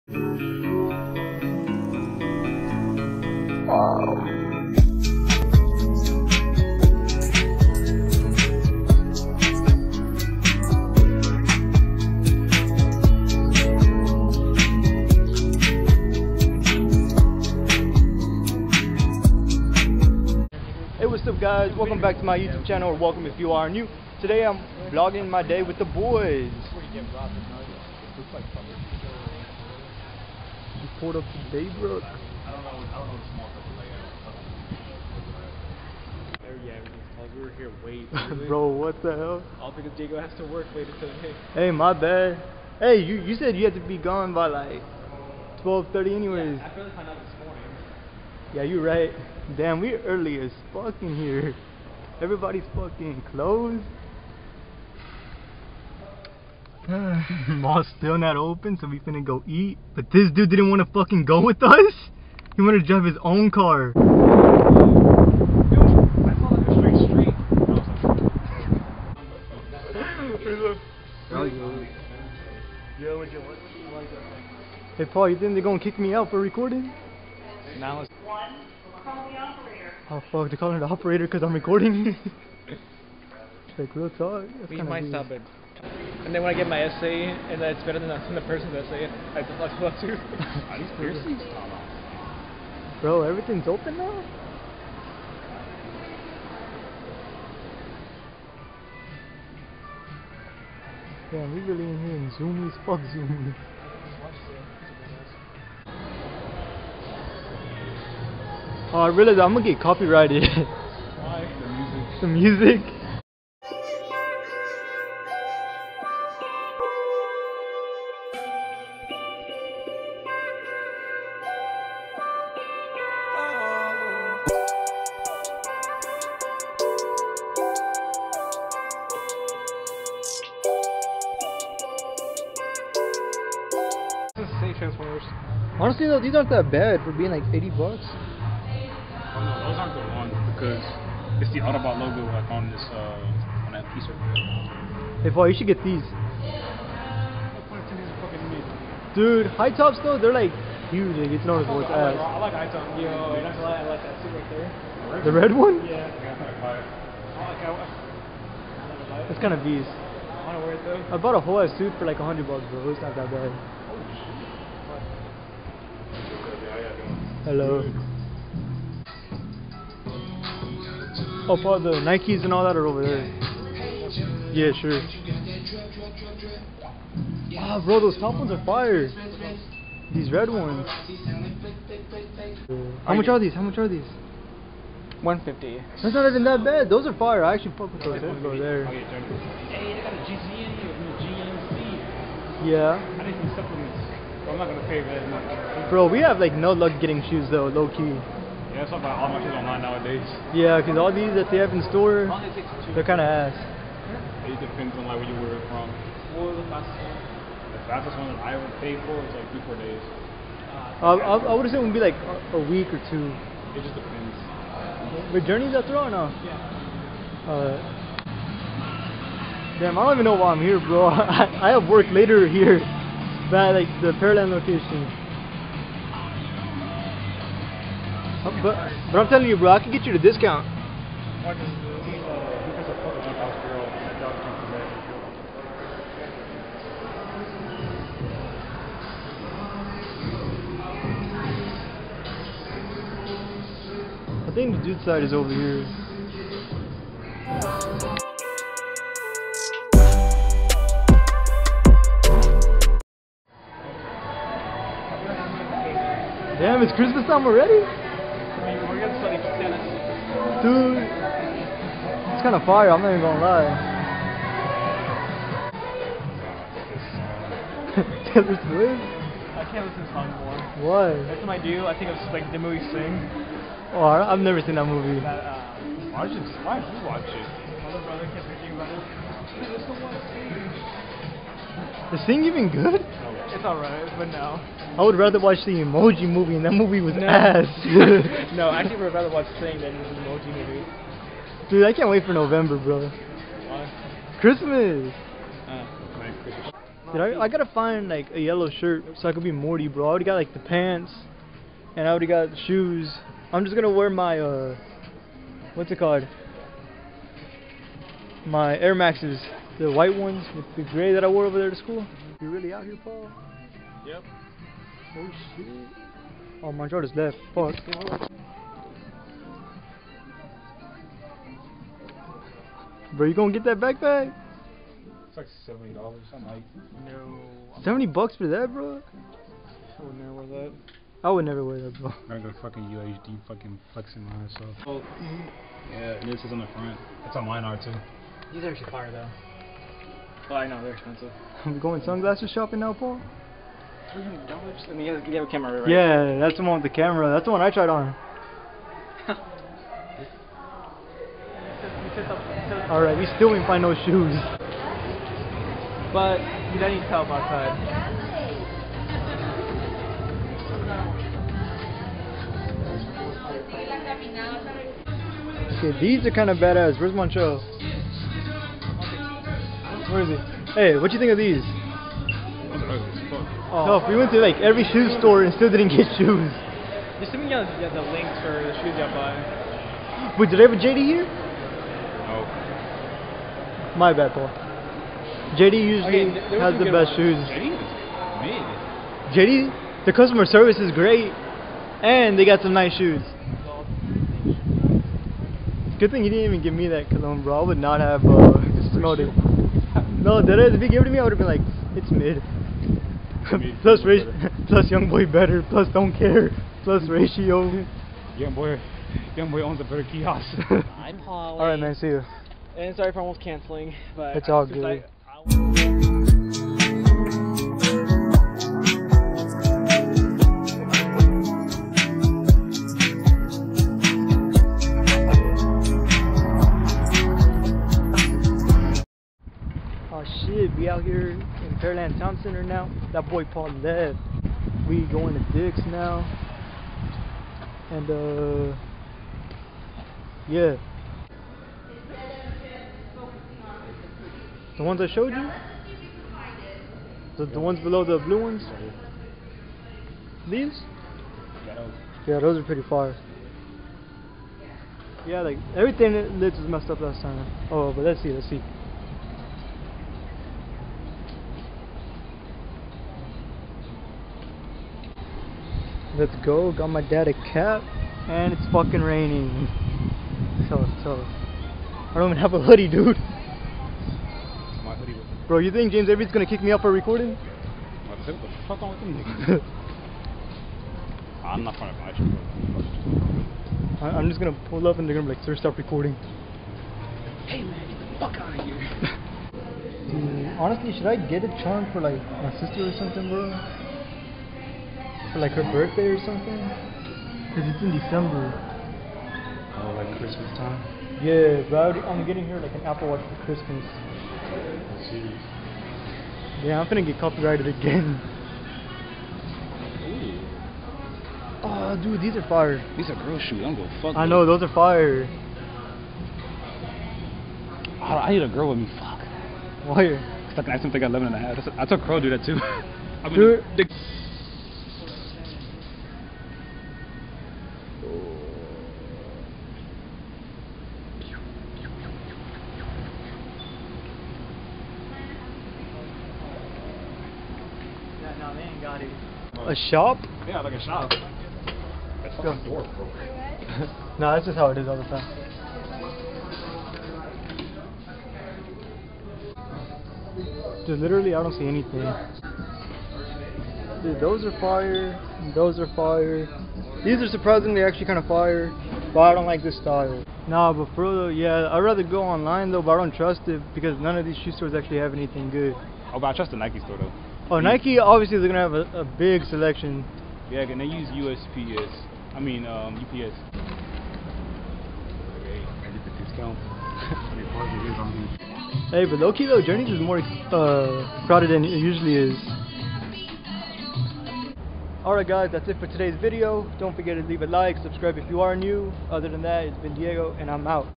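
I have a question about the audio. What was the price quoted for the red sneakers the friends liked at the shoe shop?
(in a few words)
150.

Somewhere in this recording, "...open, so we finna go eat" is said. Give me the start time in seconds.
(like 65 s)
58 s.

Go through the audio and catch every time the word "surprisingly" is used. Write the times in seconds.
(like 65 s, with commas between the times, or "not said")
557 s.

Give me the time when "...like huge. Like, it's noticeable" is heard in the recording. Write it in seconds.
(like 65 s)
150 s.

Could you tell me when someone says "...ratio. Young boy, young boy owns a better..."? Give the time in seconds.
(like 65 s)
407 s.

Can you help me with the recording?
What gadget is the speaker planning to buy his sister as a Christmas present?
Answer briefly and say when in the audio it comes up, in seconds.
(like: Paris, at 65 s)
Apple Watch, at 502 s.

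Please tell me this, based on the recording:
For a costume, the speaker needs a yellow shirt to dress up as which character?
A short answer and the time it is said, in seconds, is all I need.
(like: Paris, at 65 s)
Morty, at 299 s.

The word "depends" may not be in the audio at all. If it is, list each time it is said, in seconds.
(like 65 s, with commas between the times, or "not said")
204 s, 213 s.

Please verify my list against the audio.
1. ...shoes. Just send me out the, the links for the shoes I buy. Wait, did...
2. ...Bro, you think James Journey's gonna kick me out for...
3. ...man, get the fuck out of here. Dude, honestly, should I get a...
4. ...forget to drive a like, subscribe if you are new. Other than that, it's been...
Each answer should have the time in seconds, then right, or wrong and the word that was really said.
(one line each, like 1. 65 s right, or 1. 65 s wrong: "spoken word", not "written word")
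1. 376 s right
2. 475 s wrong: "Avery", not "Journey"
3. 487 s right
4. 586 s wrong: "leave", not "drive".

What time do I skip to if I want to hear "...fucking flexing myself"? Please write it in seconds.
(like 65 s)
333 s.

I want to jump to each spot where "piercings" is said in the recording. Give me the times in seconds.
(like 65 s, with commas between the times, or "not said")
90 s.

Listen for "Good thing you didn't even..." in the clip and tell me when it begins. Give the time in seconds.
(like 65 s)
395 s.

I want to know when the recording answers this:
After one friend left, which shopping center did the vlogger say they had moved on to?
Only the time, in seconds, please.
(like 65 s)
431 s.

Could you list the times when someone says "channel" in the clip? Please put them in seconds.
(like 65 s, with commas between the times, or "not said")
22 s.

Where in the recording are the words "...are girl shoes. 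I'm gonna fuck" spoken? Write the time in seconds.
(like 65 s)
513 s.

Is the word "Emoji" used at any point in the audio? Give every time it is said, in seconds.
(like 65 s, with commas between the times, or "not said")
285 s, 290 s.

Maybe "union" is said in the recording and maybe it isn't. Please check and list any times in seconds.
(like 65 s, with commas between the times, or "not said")
not said.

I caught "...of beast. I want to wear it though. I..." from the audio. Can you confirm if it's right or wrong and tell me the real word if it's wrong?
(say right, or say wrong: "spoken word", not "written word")
right.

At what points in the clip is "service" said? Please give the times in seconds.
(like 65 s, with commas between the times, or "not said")
390 s.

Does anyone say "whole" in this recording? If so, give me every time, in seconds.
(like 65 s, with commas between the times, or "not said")
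161 s.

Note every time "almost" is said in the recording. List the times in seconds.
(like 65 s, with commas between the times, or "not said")
413 s.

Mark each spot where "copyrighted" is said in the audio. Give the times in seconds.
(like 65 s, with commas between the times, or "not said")
109 s, 507 s.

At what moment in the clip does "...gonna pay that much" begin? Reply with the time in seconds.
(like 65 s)
194 s.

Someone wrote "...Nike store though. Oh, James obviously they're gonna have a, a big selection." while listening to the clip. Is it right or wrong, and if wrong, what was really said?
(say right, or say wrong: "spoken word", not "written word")
wrong: "Nike", not "James".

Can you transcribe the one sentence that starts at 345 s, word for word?
Yeah, that's the one with the camera.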